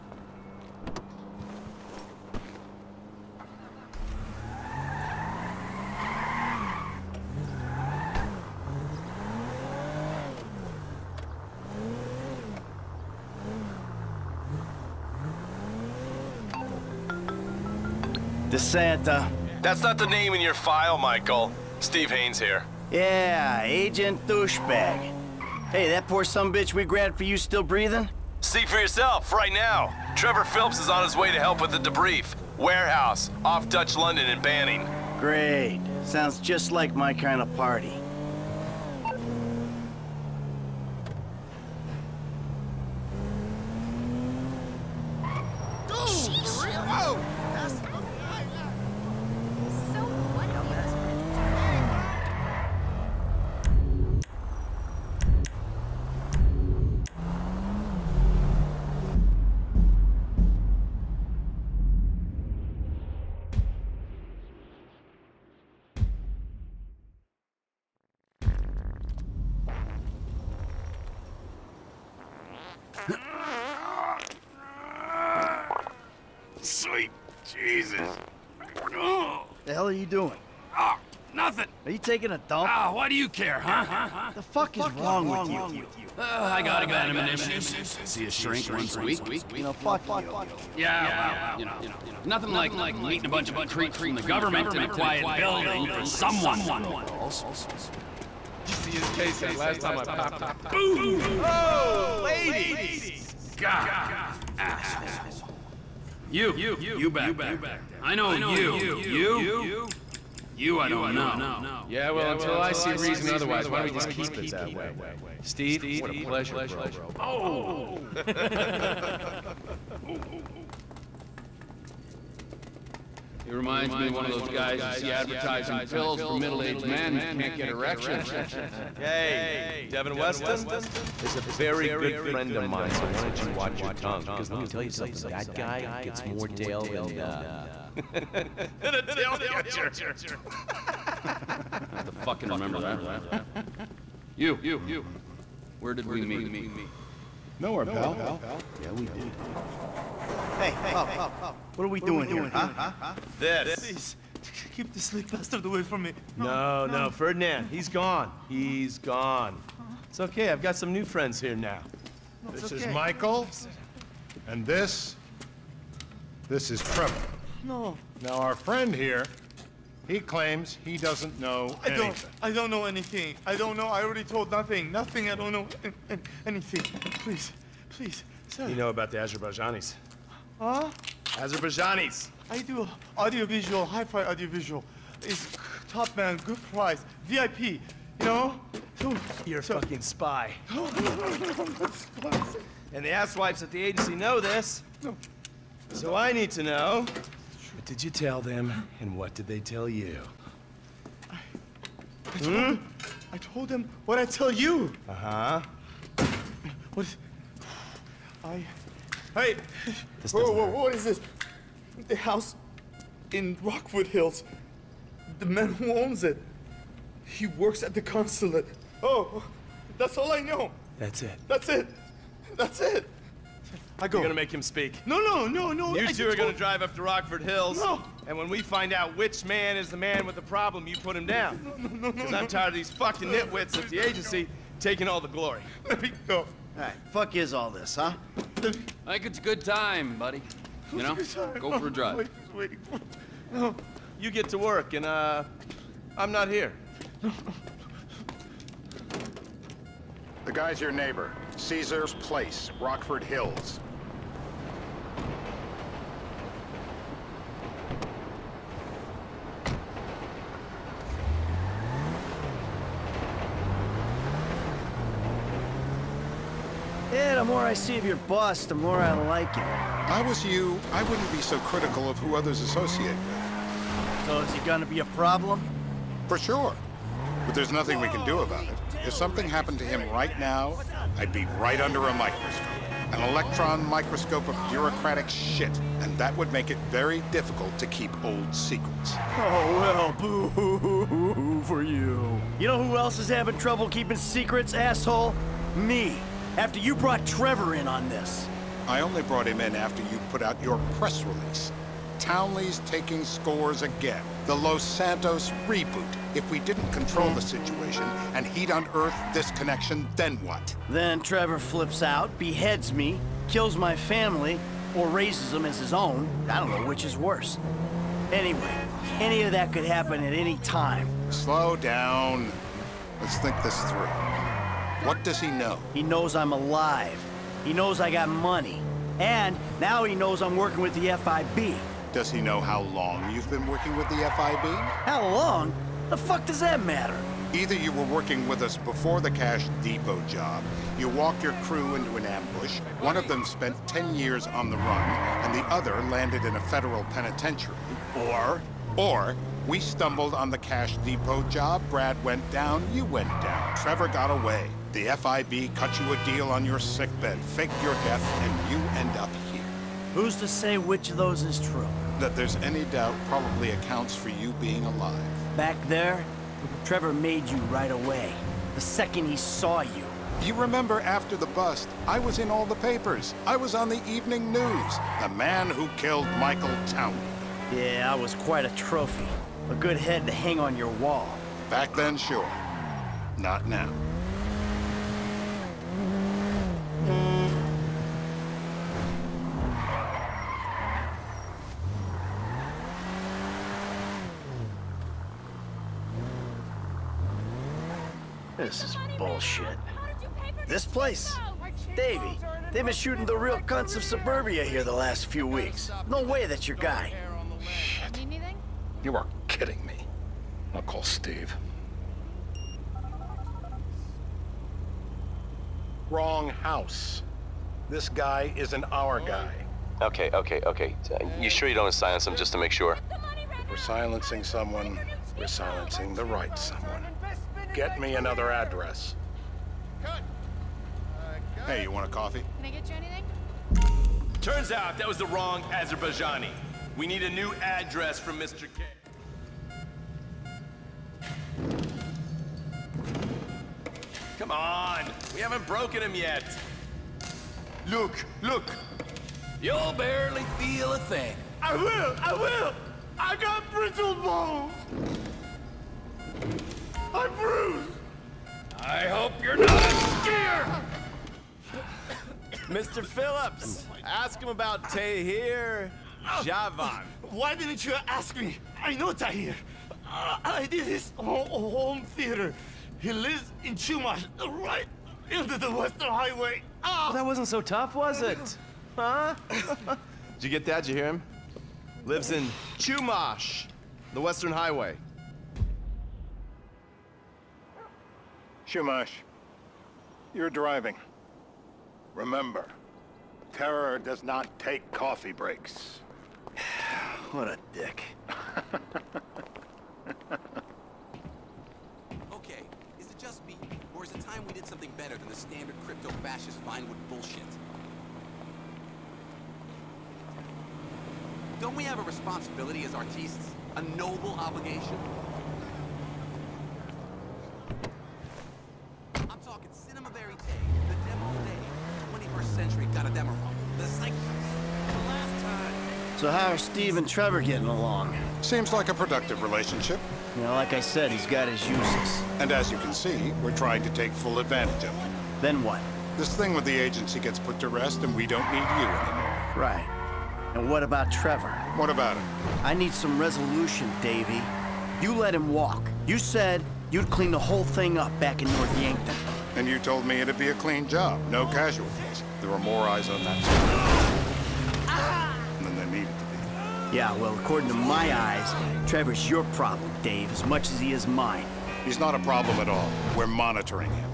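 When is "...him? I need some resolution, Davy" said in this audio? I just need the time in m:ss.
9:02.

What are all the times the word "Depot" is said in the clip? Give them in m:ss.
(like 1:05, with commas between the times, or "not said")
5:39, 5:50.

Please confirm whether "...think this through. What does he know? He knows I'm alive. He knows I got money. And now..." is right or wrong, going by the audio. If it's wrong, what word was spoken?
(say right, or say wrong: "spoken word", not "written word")
right.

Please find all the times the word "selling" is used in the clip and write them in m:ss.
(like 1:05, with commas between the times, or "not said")
not said.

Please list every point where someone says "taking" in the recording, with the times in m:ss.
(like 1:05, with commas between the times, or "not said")
1:21, 3:54, 5:02.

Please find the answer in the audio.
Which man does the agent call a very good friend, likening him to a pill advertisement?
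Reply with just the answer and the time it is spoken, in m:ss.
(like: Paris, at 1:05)
Devin Weston, at 2:09.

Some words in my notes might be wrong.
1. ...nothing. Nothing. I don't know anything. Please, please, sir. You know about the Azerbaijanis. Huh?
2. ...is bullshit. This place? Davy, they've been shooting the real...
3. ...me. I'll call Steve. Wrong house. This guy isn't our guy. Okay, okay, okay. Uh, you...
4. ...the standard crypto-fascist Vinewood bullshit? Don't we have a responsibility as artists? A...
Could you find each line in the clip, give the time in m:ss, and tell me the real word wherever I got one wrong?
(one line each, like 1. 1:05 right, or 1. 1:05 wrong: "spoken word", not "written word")
1. 2:54 right
2. 6:38 right
3. 6:49 right
4. 8:25 right.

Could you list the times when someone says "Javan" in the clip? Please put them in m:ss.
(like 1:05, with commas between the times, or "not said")
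7:46.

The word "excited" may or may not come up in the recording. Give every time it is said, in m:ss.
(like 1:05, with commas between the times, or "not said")
not said.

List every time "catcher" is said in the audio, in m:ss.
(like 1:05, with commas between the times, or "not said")
2:19.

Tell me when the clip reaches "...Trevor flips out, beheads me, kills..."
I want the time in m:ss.
5:11.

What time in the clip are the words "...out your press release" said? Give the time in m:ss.
5:00.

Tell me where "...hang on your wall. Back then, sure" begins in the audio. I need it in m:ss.
6:20.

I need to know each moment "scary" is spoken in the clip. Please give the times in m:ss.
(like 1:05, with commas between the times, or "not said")
not said.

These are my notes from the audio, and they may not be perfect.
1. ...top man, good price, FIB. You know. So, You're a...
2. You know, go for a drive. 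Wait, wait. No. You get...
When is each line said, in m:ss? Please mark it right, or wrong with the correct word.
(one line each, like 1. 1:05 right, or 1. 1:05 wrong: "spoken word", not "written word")
1. 3:05 wrong: "VIP", not "FIB"
2. 4:00 right.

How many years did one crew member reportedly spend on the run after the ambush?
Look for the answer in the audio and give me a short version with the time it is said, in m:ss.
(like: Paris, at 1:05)
10 years, at 5:43.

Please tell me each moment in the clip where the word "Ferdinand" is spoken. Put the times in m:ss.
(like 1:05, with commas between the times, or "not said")
2:37.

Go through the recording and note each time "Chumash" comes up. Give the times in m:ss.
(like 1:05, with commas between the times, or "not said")
7:53, 8:02, 8:08.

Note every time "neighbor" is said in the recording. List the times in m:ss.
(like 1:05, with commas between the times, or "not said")
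4:10.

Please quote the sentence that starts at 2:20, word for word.
I have to fucking remember that line.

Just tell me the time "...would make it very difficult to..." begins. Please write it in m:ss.
4:46.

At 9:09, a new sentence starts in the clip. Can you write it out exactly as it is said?
And you told me it'd be a clean job, no casualties.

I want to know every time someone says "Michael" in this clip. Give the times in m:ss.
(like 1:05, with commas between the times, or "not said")
0:20, 2:42, 6:16.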